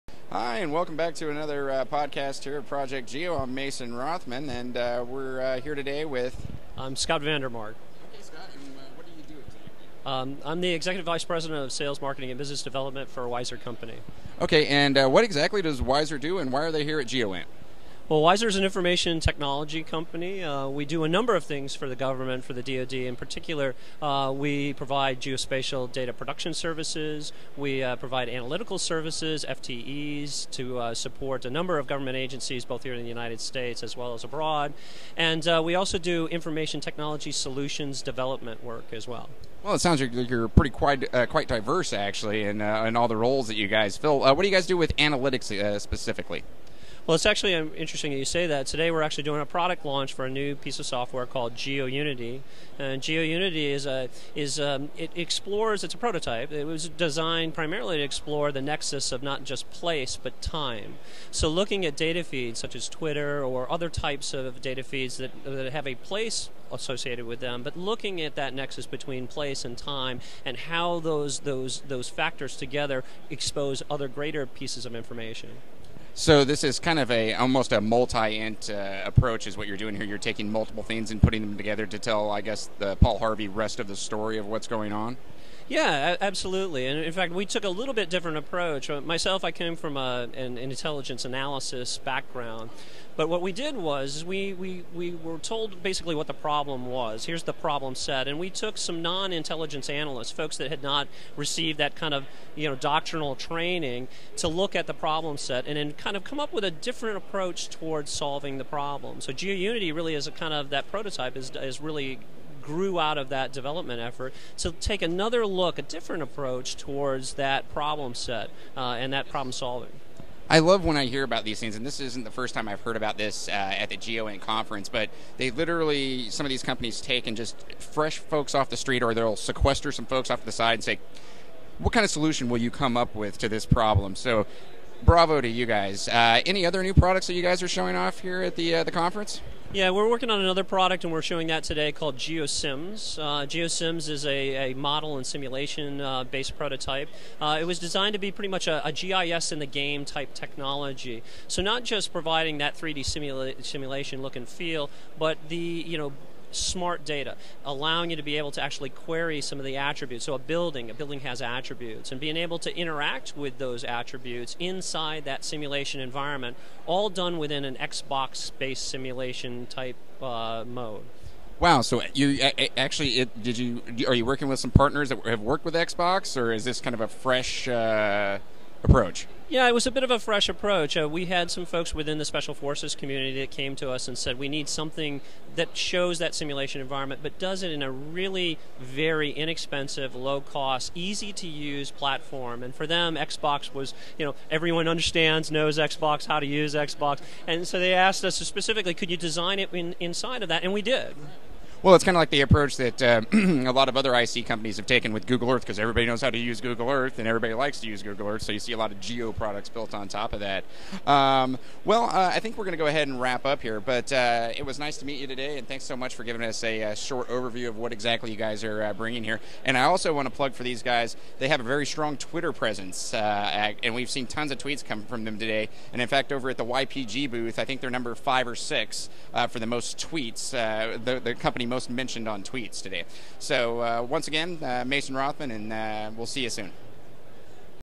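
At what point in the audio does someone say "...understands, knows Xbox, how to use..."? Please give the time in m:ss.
3:14.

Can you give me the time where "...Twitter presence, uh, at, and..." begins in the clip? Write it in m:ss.
3:42.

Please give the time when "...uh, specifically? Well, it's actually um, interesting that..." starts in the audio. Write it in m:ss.
0:45.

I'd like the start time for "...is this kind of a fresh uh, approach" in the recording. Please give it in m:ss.
2:56.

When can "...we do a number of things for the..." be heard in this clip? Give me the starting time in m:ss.
0:20.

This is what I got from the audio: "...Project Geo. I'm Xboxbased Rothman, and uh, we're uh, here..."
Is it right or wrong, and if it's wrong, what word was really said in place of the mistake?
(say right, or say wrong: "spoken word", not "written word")
wrong: "Mason", not "Xboxbased".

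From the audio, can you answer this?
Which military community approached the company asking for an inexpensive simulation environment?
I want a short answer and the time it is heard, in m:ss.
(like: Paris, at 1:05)
Special Forces, at 3:02.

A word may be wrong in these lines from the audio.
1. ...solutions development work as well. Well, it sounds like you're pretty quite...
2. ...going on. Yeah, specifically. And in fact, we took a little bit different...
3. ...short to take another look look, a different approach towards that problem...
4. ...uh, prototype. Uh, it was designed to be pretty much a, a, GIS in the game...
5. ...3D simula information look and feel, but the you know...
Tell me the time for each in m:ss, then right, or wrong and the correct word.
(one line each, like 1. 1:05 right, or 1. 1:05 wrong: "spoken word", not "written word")
1. 0:37 right
2. 1:24 wrong: "absolutely", not "specifically"
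3. 1:53 wrong: "effort", not "short"
4. 2:26 right
5. 2:32 wrong: "simulation", not "information".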